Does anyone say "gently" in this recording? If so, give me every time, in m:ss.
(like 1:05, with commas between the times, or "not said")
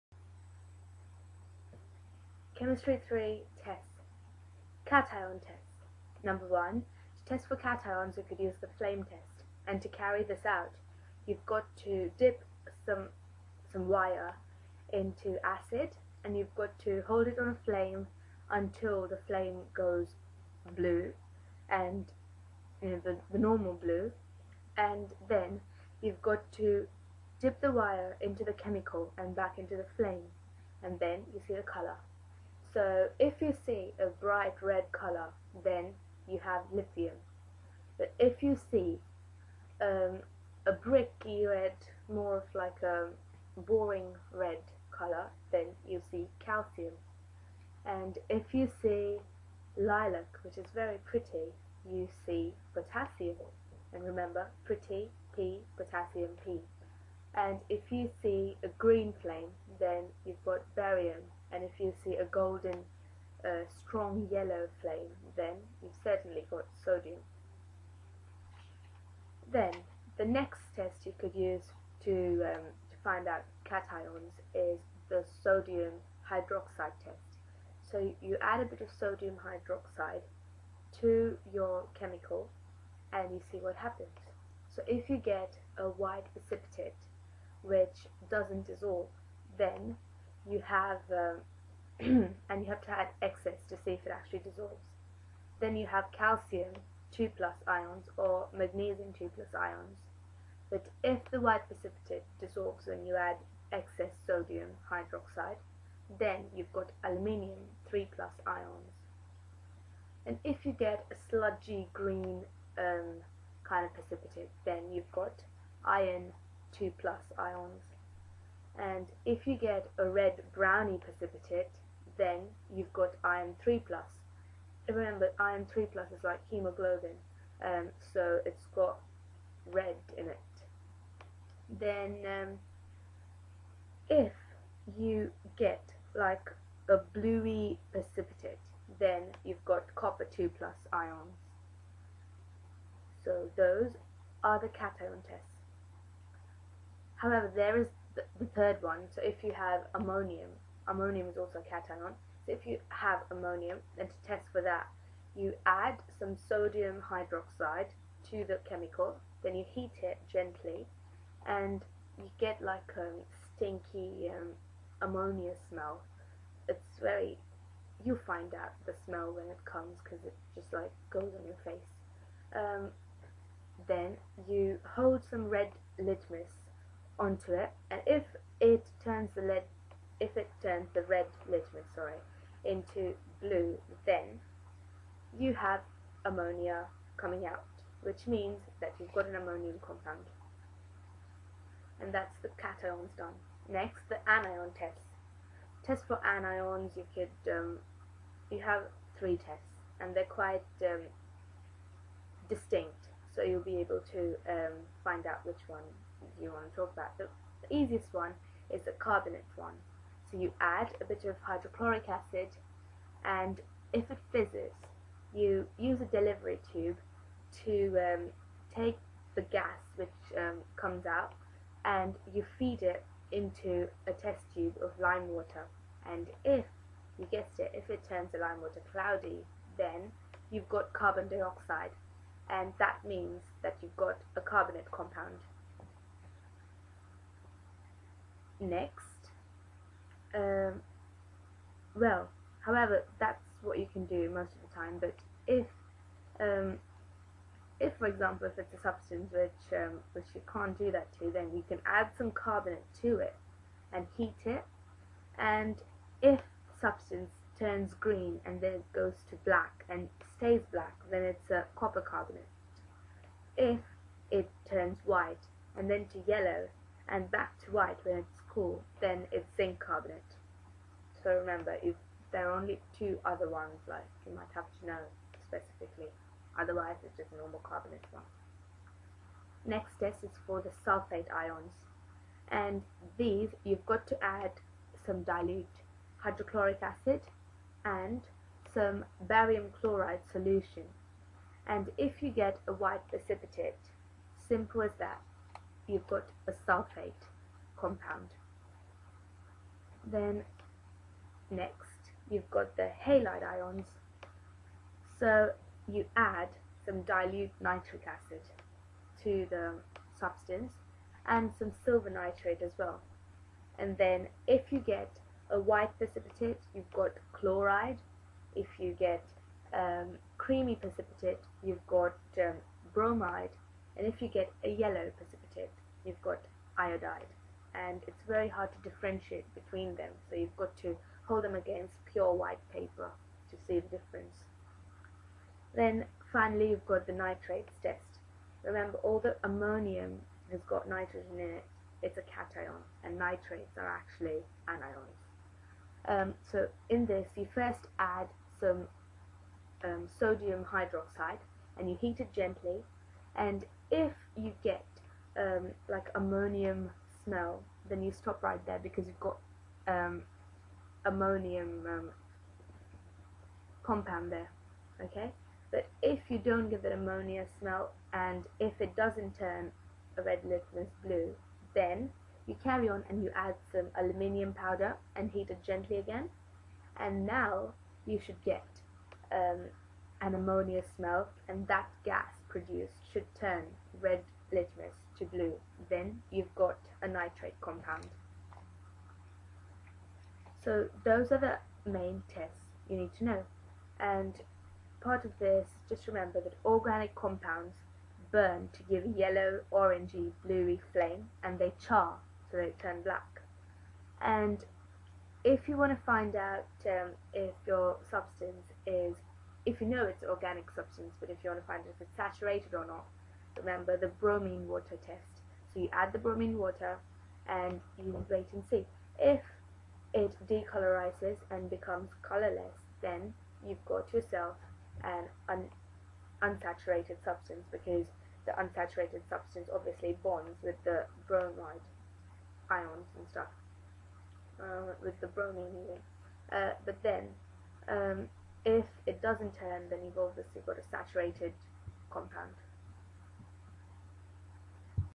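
2:40, 5:52, 6:15.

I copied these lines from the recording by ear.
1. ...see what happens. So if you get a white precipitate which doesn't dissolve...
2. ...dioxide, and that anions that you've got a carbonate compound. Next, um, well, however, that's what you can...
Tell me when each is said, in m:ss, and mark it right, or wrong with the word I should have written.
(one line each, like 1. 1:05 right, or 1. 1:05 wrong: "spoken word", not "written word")
1. 1:23 right
2. 3:51 wrong: "means", not "anions".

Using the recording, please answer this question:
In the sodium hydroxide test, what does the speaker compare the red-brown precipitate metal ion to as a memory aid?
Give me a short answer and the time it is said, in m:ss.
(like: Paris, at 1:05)
hemoglobin, at 2:06.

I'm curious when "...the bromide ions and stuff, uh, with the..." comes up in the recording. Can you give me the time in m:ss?
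7:10.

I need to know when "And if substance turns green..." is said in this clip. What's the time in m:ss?
4:15.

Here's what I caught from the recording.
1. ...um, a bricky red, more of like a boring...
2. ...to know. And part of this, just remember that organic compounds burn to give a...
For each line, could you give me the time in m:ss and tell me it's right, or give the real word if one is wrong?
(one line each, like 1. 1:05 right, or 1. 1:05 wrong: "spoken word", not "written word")
1. 0:39 right
2. 6:33 right.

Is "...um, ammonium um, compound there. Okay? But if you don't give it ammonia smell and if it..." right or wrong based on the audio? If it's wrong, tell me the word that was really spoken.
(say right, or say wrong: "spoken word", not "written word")
right.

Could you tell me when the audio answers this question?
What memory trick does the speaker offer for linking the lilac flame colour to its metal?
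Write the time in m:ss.
0:54.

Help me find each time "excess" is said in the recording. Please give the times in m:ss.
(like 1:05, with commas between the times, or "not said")
1:33, 1:43.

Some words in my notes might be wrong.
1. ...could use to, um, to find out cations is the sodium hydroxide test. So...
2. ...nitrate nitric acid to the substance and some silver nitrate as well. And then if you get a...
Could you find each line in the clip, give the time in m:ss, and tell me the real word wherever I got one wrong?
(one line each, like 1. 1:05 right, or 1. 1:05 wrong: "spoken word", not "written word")
1. 1:11 right
2. 5:07 wrong: "dilute", not "nitrate".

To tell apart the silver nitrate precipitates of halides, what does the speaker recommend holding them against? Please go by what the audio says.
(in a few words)
pure white paper.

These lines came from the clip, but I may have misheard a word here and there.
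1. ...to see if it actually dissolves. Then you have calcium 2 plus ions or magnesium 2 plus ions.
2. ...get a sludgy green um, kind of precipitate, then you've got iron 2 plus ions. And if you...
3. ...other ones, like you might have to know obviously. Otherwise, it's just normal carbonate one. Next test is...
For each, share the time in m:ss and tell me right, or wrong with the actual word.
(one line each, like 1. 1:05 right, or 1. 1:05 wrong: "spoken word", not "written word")
1. 1:33 right
2. 1:50 right
3. 4:33 wrong: "specifically", not "obviously".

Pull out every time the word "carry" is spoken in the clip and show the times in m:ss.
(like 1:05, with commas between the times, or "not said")
0:09, 6:12.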